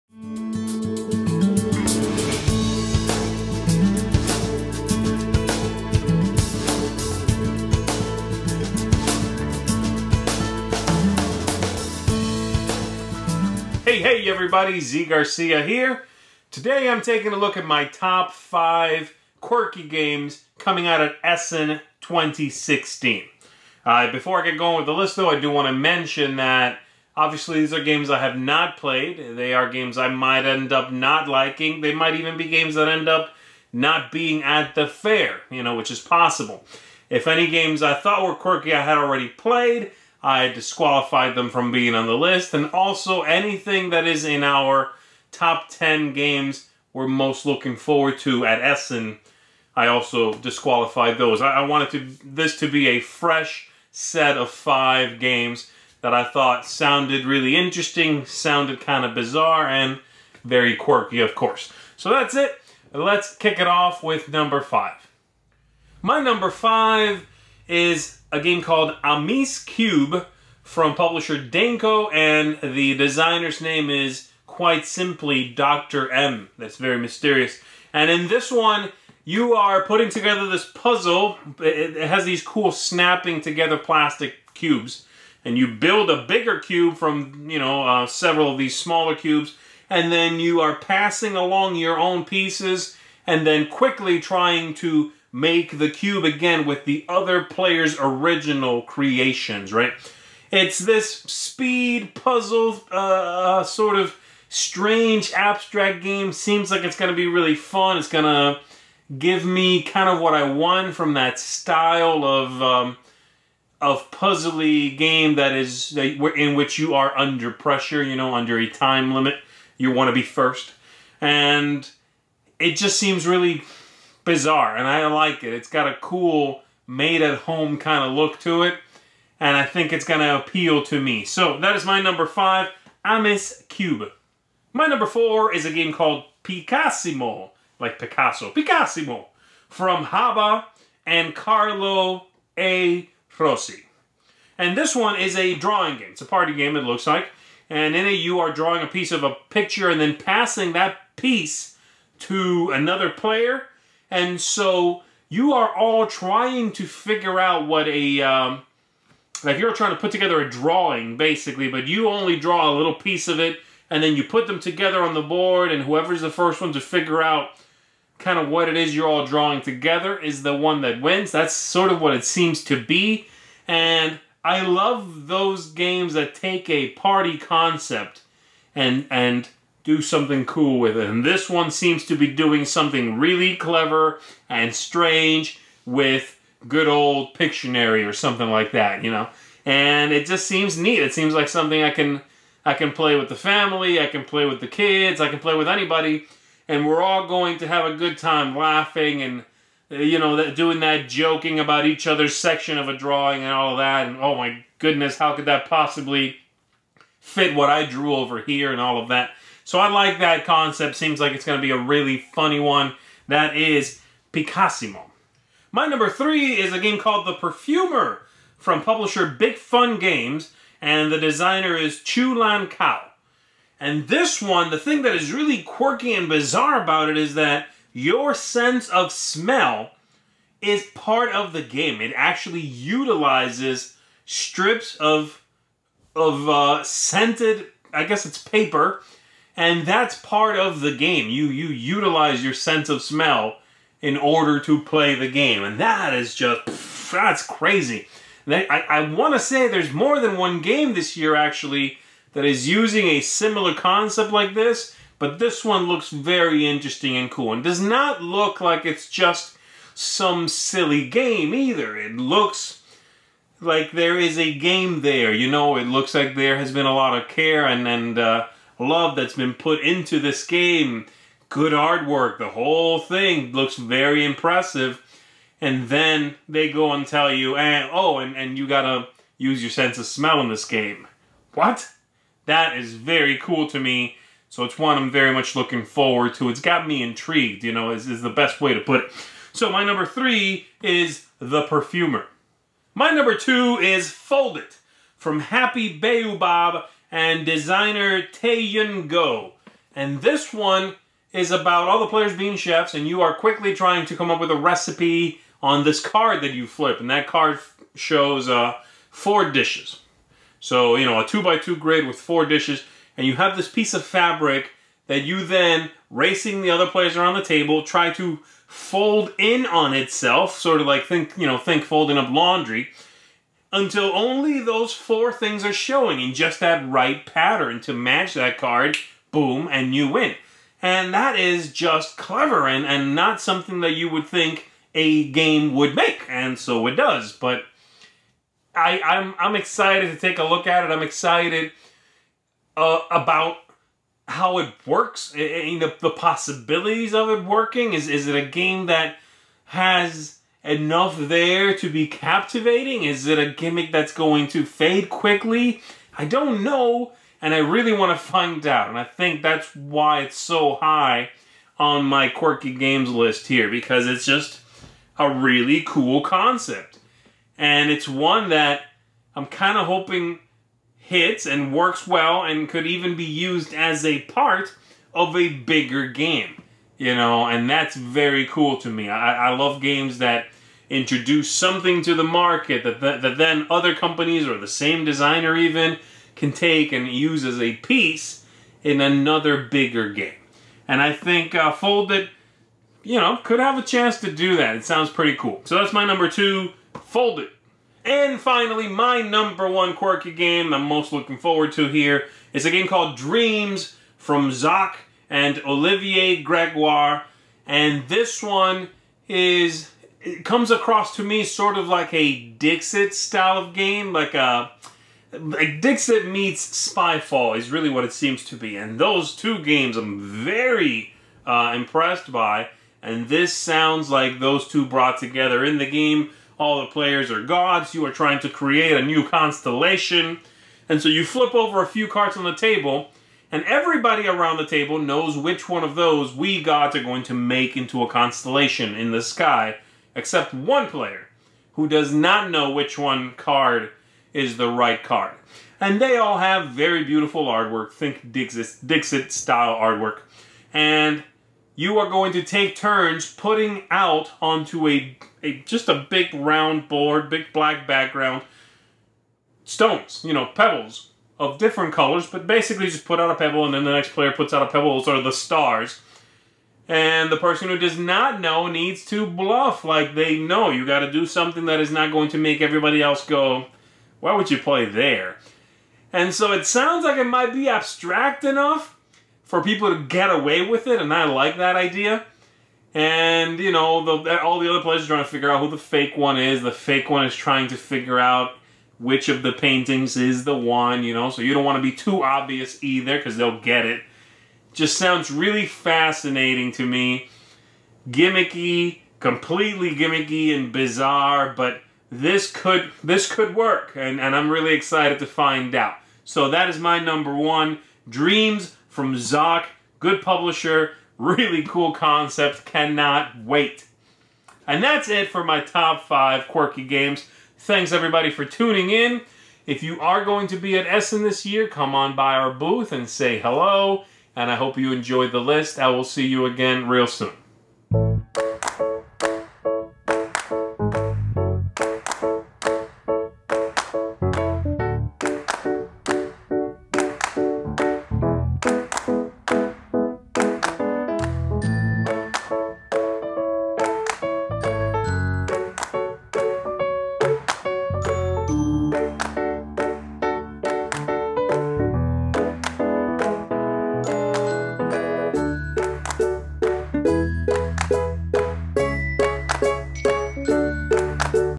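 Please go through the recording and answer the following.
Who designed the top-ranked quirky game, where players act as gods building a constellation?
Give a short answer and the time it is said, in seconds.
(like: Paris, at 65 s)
Olivier Gregoire, at 405 s.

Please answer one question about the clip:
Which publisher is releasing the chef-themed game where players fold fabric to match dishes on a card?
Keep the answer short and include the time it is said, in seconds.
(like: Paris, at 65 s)
Happy Baobab, at 295 s.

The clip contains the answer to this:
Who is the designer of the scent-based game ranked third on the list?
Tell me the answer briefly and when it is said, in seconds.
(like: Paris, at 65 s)
Chu Lan Kao, at 222 s.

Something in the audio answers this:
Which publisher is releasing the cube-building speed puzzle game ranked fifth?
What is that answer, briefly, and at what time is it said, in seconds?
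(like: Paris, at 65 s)
Denko, at 71 s.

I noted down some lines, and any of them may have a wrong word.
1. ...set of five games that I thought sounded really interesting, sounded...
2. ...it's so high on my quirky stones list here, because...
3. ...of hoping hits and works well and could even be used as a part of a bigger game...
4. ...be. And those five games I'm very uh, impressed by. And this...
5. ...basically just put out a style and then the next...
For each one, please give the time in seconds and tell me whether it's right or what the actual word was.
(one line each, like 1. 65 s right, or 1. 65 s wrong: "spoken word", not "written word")
1. 53 s right
2. 360 s wrong: "games", not "stones"
3. 369 s right
4. 418 s wrong: "two", not "five"
5. 462 s wrong: "pebble", not "style".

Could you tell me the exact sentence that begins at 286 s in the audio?
It's got me intrigued, you know, is, is the best way to put it.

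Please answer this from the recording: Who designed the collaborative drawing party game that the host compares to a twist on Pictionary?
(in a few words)
Carlo A. Rossi.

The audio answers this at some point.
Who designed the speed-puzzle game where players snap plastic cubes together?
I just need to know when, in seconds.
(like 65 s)
75 s.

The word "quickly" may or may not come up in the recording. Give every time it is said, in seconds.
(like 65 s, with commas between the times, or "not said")
93 s, 303 s, 355 s.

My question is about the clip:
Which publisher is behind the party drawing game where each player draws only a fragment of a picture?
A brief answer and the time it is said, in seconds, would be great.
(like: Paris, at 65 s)
Haba, at 140 s.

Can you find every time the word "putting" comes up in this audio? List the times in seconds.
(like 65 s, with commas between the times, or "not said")
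79 s, 453 s.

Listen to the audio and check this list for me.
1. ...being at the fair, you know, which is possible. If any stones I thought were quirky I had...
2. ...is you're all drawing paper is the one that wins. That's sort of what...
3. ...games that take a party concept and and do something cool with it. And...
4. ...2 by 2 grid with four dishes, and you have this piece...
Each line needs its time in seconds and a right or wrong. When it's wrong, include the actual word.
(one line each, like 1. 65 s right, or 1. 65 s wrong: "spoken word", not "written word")
1. 34 s wrong: "games", not "stones"
2. 168 s wrong: "together", not "paper"
3. 175 s right
4. 311 s right.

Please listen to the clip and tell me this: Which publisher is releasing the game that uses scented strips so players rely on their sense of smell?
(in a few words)
Big Fun Games.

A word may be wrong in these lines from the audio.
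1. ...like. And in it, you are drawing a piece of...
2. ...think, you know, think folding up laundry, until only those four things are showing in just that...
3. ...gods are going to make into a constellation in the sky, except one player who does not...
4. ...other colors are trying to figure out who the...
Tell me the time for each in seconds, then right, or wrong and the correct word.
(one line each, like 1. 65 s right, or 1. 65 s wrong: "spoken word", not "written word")
1. 147 s right
2. 321 s right
3. 436 s right
4. 484 s wrong: "players", not "colors".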